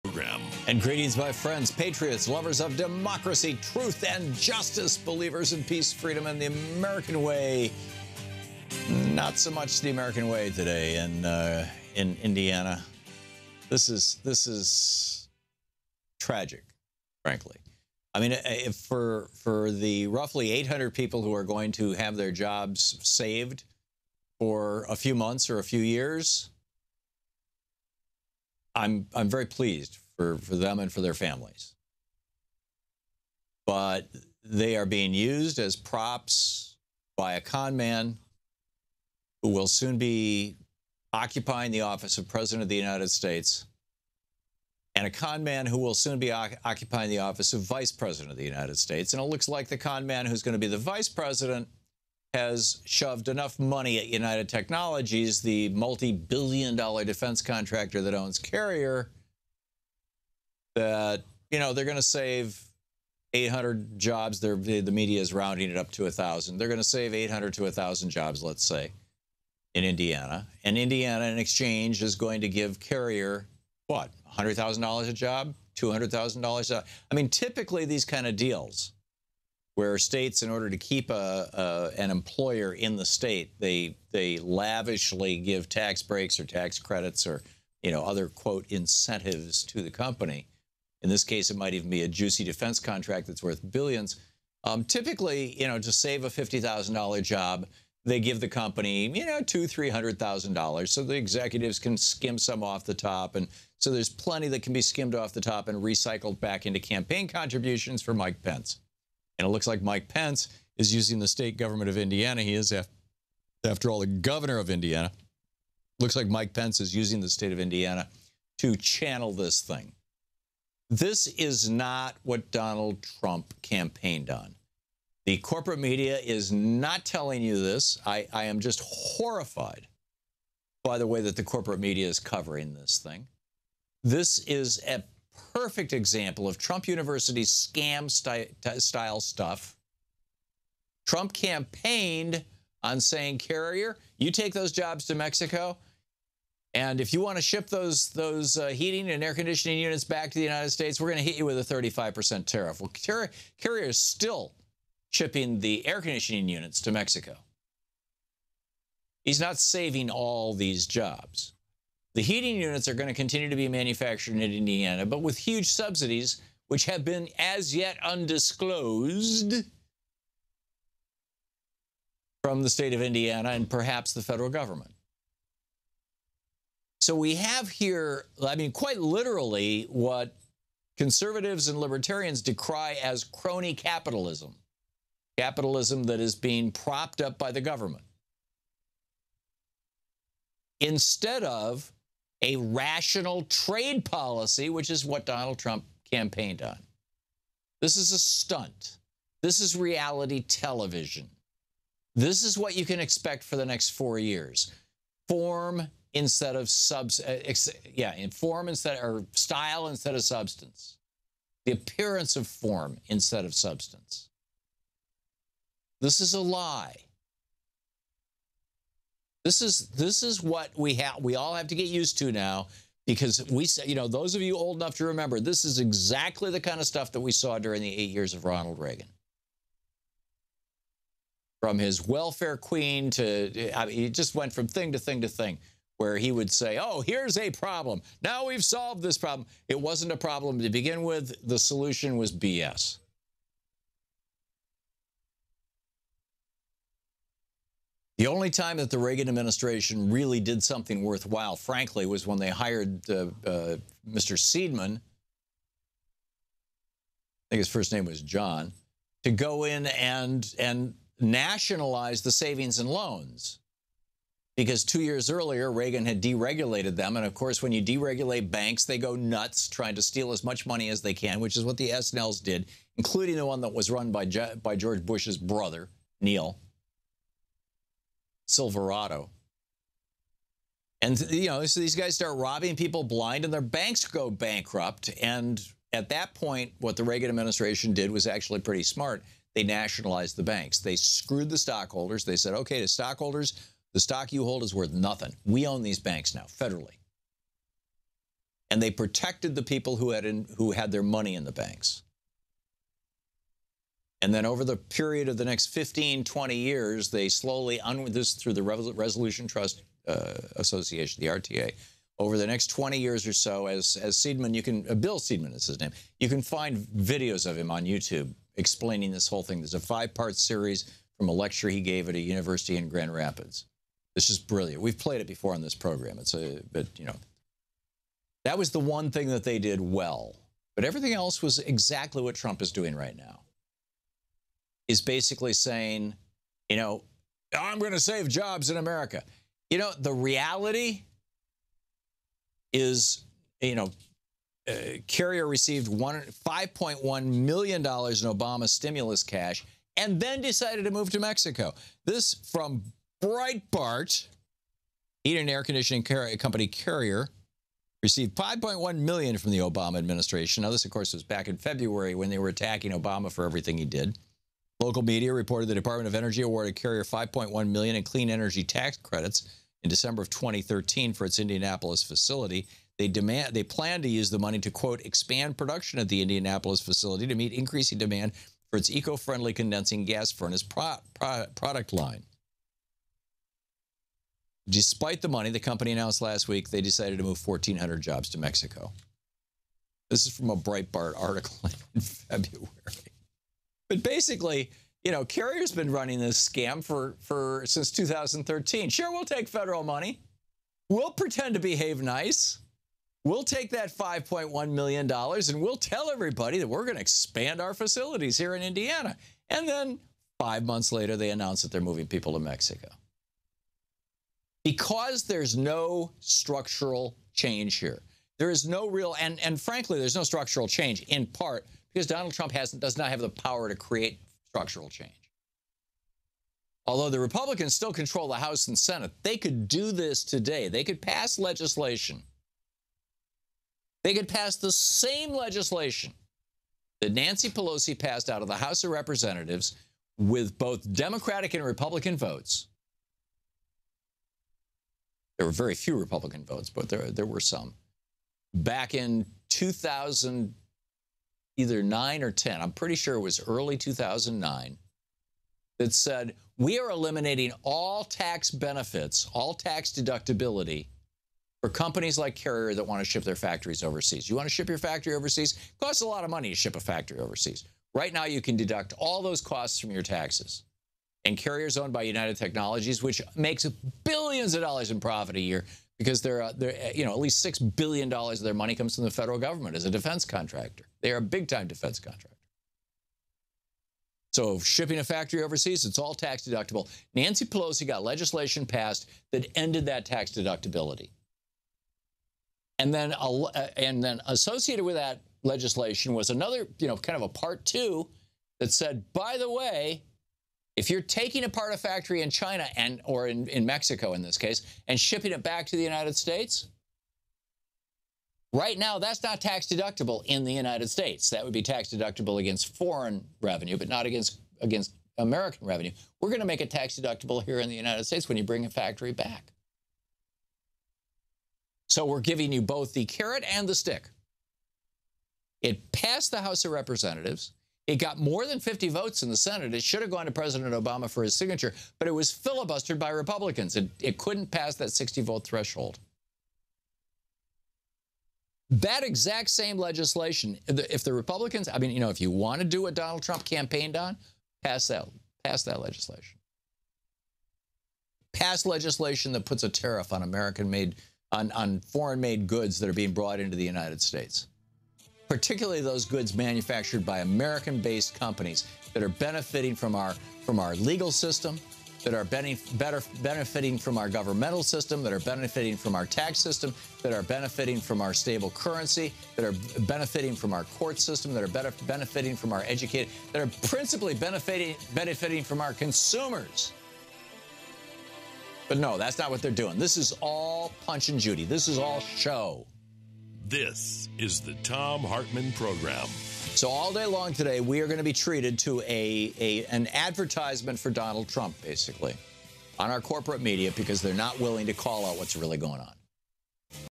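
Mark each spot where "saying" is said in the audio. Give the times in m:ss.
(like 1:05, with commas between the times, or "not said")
2:22, 5:35.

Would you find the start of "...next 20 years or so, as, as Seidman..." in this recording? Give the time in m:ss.
5:12.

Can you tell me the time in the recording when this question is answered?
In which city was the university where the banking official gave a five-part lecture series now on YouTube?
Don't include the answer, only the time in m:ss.
5:22.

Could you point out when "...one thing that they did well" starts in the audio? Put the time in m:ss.
5:28.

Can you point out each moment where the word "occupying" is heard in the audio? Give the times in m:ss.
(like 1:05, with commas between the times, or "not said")
0:41, 0:46.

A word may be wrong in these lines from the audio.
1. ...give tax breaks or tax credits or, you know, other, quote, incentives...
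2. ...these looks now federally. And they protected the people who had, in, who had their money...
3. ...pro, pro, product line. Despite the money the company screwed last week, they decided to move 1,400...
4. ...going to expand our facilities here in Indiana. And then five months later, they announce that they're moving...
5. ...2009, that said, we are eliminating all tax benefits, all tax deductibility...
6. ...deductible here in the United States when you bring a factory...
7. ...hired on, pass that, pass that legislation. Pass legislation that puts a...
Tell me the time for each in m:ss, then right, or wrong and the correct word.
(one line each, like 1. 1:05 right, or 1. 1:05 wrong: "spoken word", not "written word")
1. 1:25 right
2. 4:55 wrong: "banks", not "looks"
3. 6:20 wrong: "announced", not "screwed"
4. 6:46 right
5. 7:33 right
6. 8:36 right
7. 9:03 wrong: "campaigned", not "hired".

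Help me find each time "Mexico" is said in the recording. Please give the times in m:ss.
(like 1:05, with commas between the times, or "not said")
2:25, 2:36, 5:51, 6:28, 6:52, 8:23.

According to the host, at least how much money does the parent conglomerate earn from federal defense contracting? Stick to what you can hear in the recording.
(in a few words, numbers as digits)
$6 billion.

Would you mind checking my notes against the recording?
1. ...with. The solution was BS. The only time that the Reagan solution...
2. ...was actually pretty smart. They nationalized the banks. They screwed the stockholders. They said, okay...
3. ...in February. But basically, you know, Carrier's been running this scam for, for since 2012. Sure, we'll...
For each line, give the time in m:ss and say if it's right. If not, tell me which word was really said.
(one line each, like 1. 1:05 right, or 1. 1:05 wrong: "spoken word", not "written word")
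1. 4:01 wrong: "administration", not "solution"
2. 4:48 right
3. 6:31 wrong: "2013", not "2012".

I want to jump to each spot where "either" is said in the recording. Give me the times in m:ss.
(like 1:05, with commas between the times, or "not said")
7:31.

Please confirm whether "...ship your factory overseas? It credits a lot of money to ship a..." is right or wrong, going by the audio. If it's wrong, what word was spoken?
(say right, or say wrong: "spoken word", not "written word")
wrong: "costs", not "credits".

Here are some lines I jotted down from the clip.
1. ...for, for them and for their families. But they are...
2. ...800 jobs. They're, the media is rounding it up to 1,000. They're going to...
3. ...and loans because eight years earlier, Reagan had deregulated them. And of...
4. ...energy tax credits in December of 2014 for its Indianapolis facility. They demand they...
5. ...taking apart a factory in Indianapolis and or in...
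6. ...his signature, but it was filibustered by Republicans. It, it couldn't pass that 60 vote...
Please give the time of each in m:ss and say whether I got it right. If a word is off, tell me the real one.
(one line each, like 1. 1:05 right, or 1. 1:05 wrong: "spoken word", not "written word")
1. 0:30 right
2. 1:03 right
3. 4:22 wrong: "two", not "eight"
4. 6:08 wrong: "2013", not "2014"
5. 8:21 wrong: "China", not "Indianapolis"
6. 8:51 right.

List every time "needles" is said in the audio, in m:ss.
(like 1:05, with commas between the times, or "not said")
not said.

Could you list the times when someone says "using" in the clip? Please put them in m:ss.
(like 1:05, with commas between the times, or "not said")
1:50, 1:56.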